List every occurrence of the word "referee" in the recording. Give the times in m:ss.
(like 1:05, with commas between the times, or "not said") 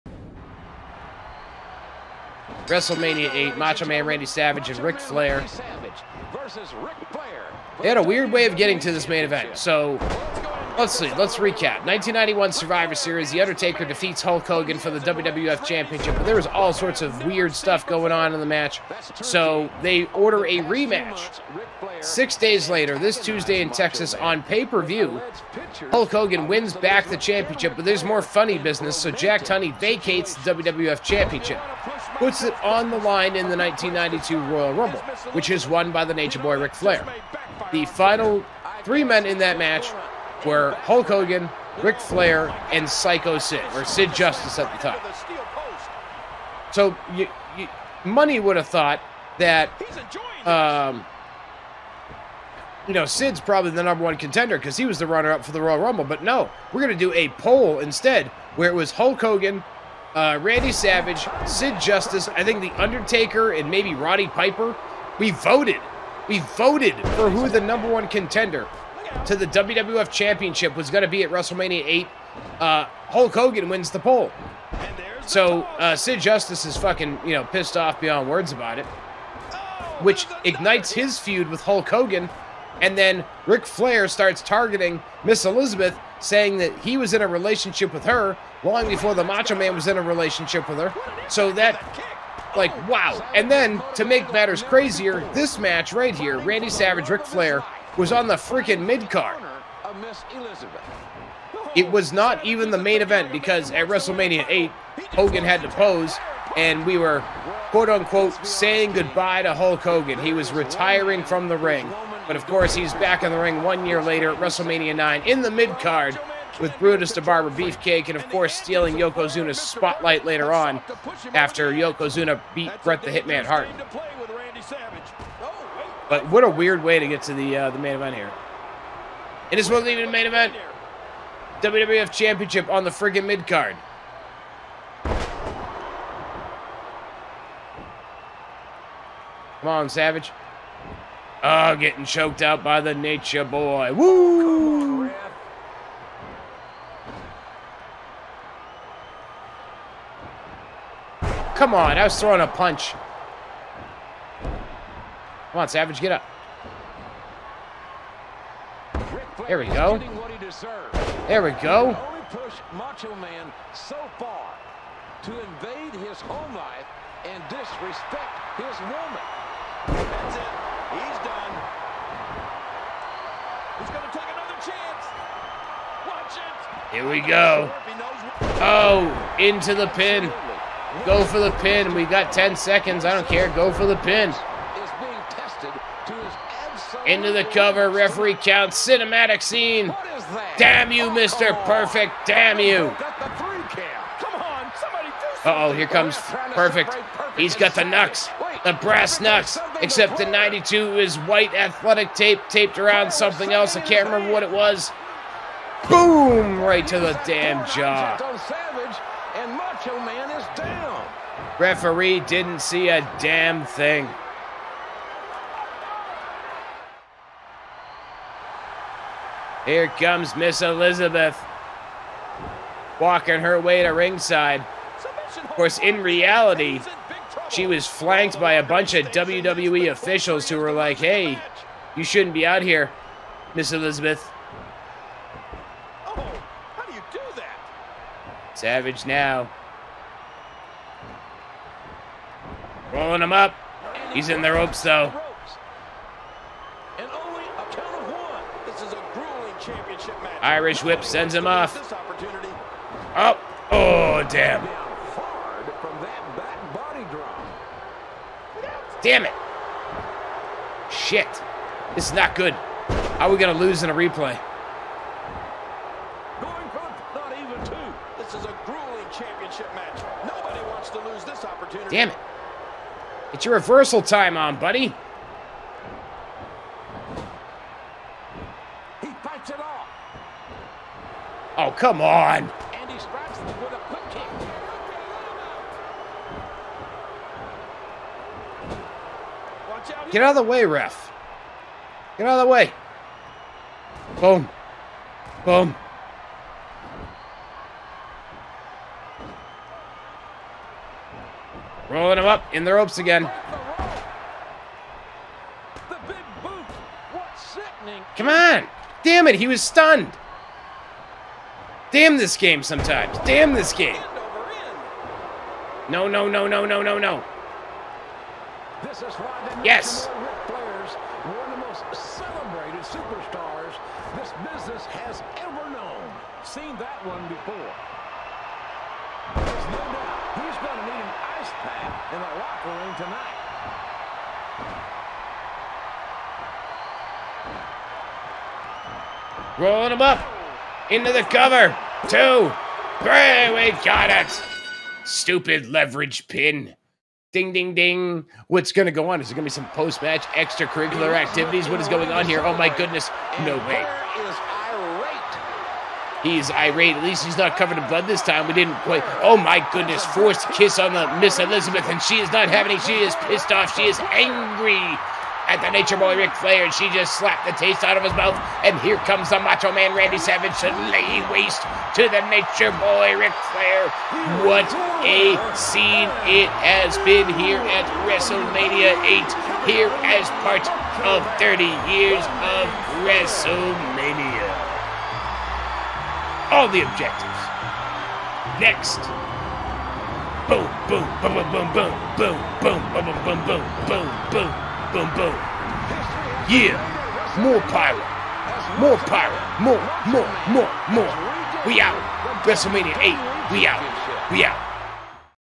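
3:07, 3:31.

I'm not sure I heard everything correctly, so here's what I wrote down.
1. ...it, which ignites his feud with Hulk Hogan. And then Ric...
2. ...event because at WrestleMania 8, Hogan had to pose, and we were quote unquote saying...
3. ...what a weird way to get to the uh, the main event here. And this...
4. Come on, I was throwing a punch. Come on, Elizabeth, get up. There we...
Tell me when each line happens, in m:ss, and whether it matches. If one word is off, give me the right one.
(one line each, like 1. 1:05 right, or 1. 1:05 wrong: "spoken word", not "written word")
1. 1:18 right
2. 1:43 right
3. 2:06 right
4. 2:31 wrong: "Savage", not "Elizabeth".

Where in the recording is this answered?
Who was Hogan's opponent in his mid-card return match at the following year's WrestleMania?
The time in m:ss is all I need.
1:56.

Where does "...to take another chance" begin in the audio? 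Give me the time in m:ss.
2:54.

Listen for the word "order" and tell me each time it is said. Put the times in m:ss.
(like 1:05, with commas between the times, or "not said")
0:20.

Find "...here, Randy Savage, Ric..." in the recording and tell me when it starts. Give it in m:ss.
1:36.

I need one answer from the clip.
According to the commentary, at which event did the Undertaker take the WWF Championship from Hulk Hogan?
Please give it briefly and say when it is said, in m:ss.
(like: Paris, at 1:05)
1991 Survivor Series, at 0:11.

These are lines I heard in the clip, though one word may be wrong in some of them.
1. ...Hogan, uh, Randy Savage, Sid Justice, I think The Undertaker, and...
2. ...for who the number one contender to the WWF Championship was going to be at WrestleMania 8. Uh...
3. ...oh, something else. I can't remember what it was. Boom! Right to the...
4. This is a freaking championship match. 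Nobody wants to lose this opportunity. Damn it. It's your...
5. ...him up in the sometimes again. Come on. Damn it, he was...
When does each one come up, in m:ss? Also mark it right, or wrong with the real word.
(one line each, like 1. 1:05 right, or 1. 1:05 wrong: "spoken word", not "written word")
1. 0:59 right
2. 1:07 right
3. 3:23 right
4. 4:28 wrong: "grueling", not "freaking"
5. 5:02 wrong: "ropes", not "sometimes".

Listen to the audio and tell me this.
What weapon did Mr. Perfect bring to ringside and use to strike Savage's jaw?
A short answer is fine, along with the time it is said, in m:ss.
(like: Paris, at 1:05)
Brass knucks, at 3:18.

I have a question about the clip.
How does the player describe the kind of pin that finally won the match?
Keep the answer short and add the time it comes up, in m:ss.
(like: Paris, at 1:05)
Leverage pin, at 5:45.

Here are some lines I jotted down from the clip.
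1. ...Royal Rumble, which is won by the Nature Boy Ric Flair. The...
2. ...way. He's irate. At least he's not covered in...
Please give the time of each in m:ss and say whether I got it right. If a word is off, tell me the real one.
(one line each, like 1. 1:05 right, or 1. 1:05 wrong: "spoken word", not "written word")
1. 0:34 right
2. 5:53 right.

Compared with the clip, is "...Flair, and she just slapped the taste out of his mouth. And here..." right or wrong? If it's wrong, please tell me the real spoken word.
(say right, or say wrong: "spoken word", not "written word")
right.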